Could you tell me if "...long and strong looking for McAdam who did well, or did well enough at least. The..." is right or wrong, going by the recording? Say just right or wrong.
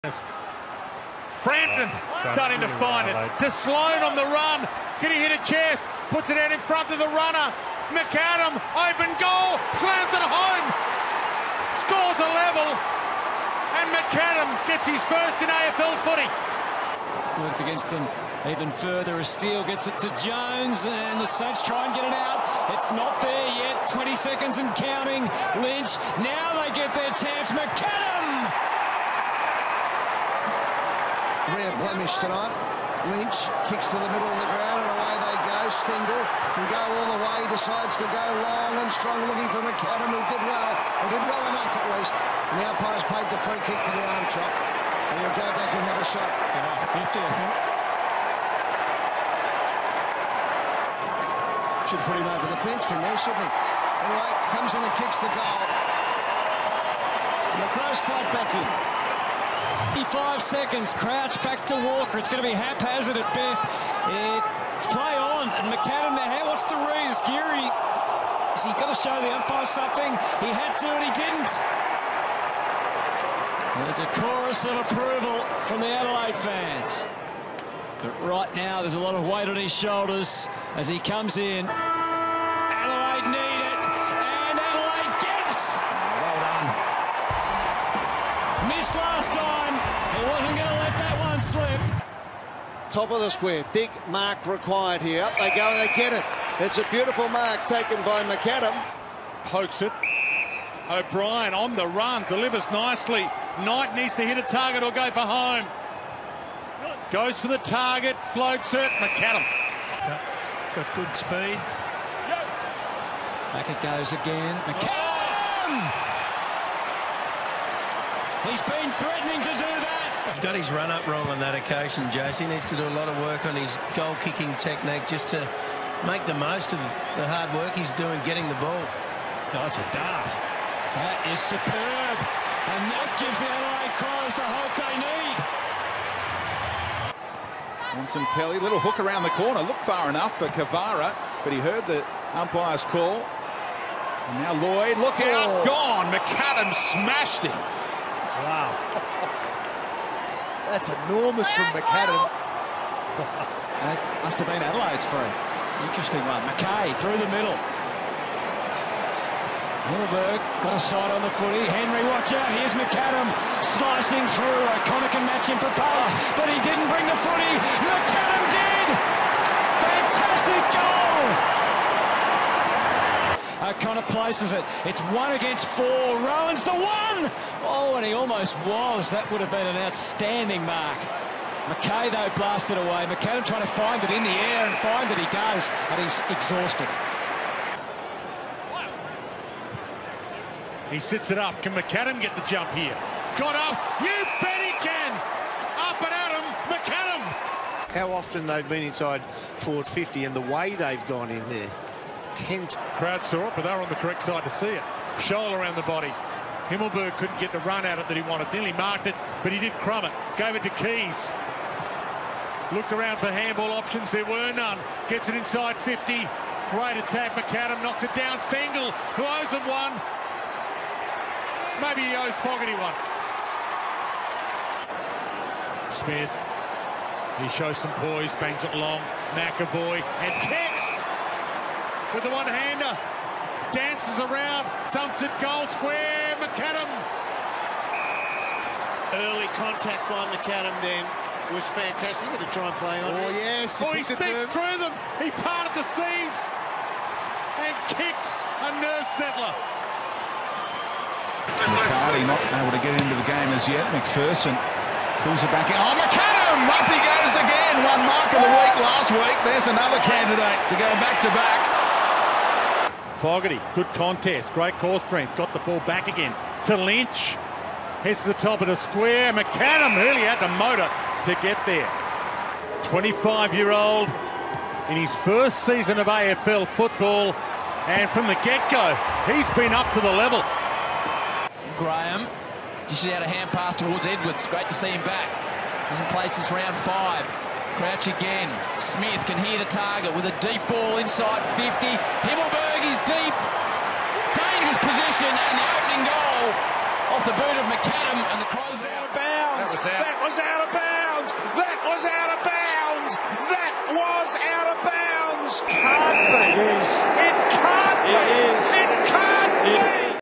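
right.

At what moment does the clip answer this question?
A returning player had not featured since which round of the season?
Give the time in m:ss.
4:46.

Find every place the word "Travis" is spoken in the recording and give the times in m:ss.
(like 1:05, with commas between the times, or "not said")
not said.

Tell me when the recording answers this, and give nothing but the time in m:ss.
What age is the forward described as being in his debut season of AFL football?
4:32.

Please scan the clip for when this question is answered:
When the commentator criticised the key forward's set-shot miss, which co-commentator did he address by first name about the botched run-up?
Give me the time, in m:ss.
2:02.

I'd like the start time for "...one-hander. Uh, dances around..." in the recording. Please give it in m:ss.
3:52.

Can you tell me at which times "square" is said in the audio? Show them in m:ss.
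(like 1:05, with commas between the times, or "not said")
1:33, 3:55, 4:28.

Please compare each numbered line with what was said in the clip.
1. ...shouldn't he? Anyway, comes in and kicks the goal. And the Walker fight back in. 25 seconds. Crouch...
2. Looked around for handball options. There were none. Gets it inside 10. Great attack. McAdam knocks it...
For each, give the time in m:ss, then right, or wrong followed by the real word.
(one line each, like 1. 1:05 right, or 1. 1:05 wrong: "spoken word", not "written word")
1. 0:53 wrong: "Crows", not "Walker"
2. 3:32 wrong: "50", not "10".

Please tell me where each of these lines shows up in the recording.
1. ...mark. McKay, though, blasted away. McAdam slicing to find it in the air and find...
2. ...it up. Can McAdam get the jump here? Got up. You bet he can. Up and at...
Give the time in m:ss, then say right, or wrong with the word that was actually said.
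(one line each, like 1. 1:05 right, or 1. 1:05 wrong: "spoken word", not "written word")
1. 3:00 wrong: "trying", not "slicing"
2. 3:11 right.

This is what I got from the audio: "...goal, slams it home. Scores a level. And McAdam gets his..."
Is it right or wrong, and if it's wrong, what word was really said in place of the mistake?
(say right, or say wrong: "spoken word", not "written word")
right.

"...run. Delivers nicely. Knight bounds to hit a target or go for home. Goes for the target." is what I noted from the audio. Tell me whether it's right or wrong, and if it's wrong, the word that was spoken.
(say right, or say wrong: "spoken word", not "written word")
wrong: "needs", not "bounds".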